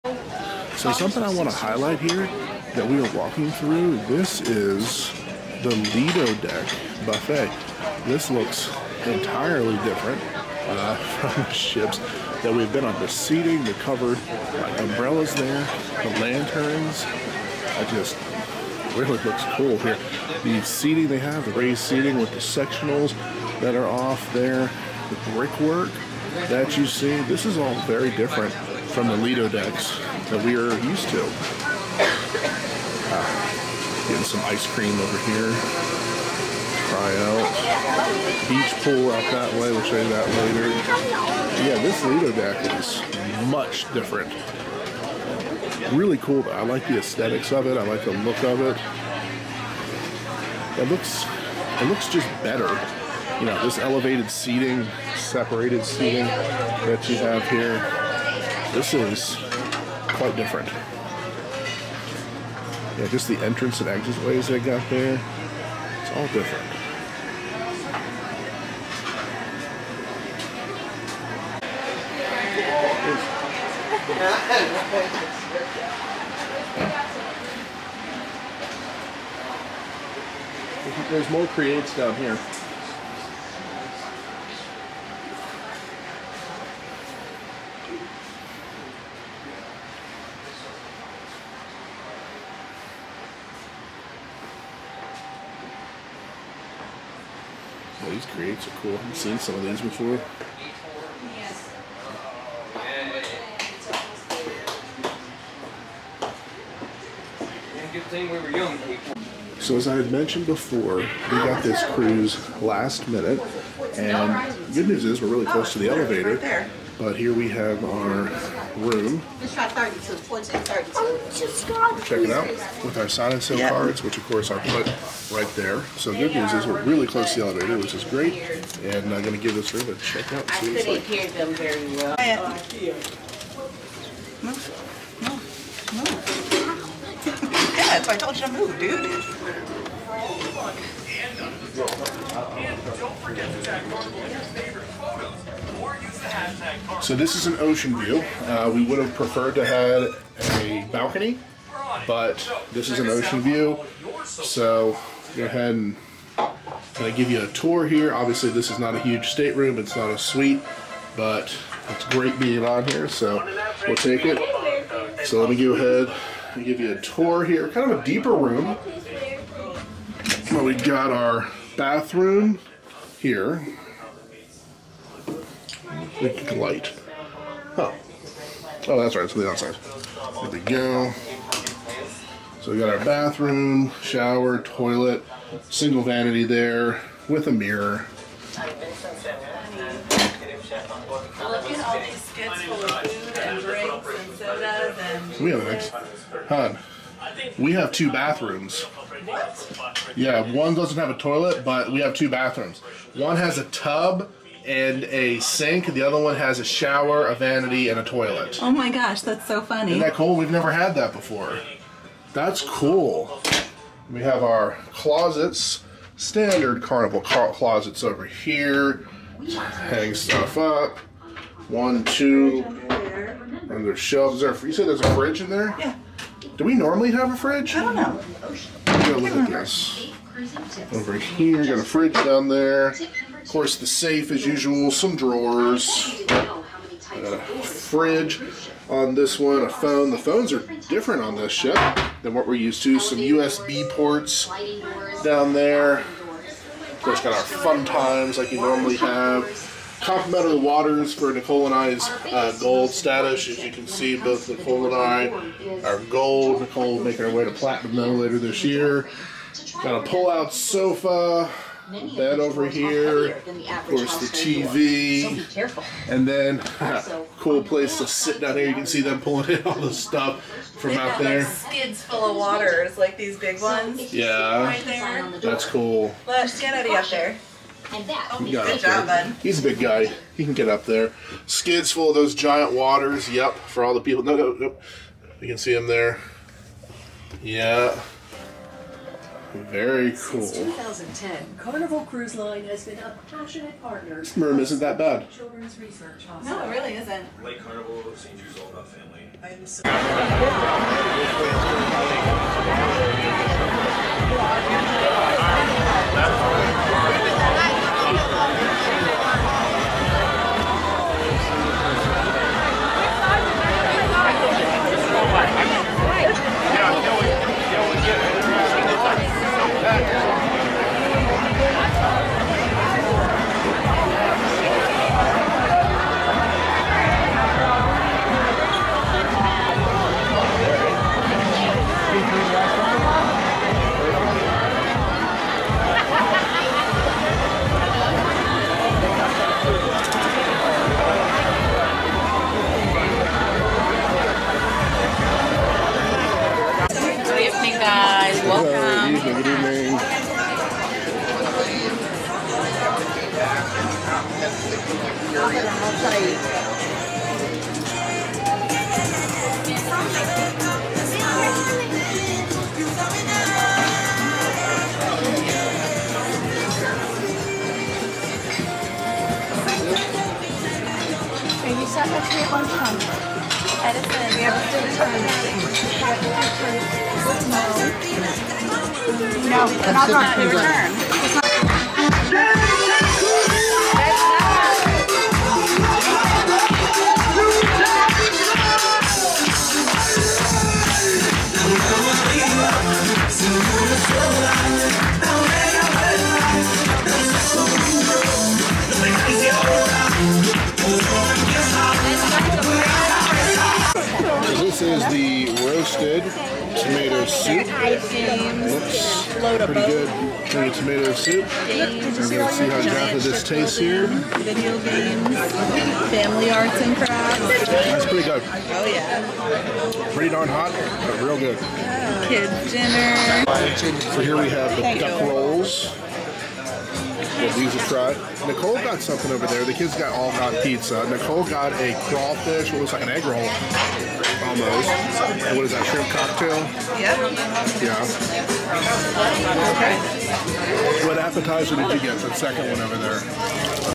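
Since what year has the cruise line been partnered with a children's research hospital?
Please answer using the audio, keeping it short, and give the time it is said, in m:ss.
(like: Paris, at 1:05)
2010, at 4:50.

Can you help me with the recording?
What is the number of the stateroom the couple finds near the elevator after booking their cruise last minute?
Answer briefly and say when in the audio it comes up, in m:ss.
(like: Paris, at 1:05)
321432, at 1:59.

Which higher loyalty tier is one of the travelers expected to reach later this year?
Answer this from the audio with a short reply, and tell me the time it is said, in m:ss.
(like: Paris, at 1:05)
platinum, at 4:17.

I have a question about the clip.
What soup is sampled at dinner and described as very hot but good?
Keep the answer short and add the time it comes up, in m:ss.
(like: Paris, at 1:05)
roasted tomato soup, at 6:45.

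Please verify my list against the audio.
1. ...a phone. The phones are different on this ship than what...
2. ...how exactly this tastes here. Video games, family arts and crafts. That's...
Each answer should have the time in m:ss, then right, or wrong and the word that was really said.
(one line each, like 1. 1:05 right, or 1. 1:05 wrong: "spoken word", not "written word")
1. 3:59 right
2. 6:52 right.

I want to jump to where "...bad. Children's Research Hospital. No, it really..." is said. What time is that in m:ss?
4:54.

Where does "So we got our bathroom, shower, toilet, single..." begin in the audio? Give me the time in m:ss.
3:02.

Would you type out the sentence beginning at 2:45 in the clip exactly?
So let me go ahead and give you a tour here.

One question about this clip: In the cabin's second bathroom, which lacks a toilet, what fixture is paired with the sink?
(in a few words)
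a tub.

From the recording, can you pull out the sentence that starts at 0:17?
I just really looks cool here.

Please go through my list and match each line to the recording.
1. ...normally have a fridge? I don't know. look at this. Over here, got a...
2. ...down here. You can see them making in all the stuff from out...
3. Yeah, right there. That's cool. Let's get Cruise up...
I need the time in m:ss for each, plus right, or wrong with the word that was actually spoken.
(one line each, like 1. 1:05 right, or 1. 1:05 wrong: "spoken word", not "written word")
1. 3:46 right
2. 4:28 wrong: "pulling", not "making"
3. 4:34 wrong: "Eddie", not "Cruise".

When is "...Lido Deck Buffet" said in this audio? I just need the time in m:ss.
0:05.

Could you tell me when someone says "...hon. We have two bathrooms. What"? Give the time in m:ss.
3:16.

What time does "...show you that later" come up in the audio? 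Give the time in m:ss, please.
0:39.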